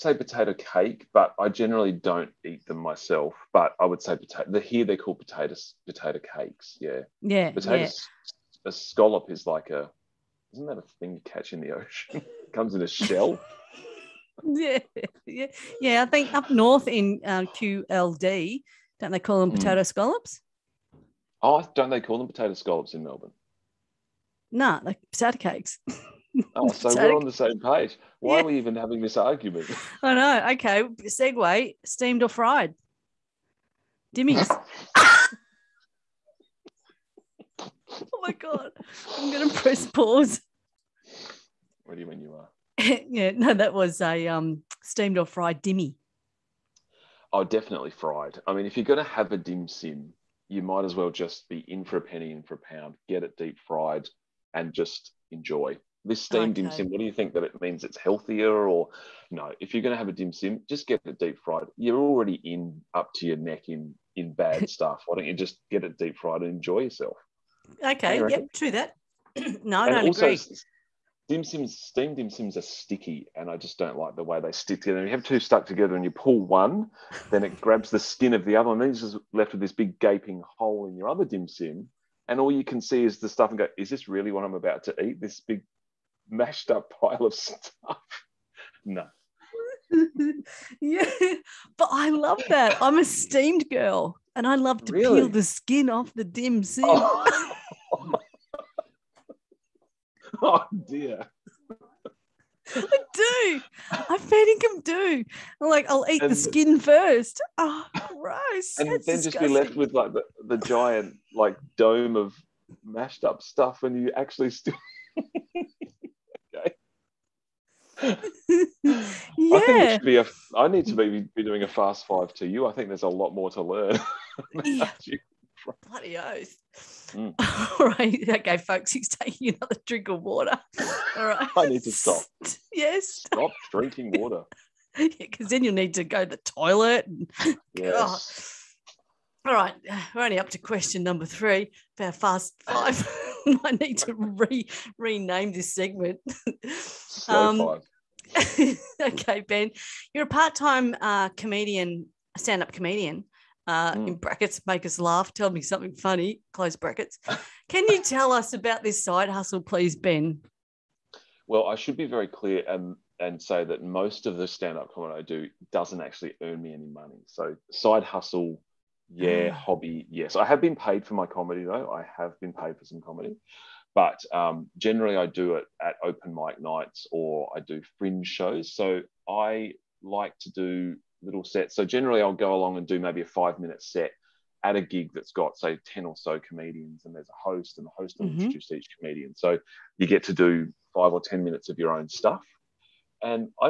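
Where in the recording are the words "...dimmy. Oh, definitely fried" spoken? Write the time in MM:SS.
00:45.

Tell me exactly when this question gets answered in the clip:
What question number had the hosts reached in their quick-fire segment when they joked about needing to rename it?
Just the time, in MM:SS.
02:21.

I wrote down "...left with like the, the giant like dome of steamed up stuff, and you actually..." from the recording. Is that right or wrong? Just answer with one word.
wrong.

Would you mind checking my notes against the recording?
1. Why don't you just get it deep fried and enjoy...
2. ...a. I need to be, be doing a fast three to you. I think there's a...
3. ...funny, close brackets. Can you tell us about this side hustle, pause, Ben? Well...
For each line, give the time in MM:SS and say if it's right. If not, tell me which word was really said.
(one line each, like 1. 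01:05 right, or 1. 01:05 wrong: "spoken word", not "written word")
1. 01:05 right
2. 02:00 wrong: "five", not "three"
3. 02:35 wrong: "please", not "pause".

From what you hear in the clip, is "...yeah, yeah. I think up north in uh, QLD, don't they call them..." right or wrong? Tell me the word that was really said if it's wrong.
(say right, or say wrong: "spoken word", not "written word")
right.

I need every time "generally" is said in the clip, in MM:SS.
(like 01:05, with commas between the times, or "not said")
00:01, 02:54, 03:01.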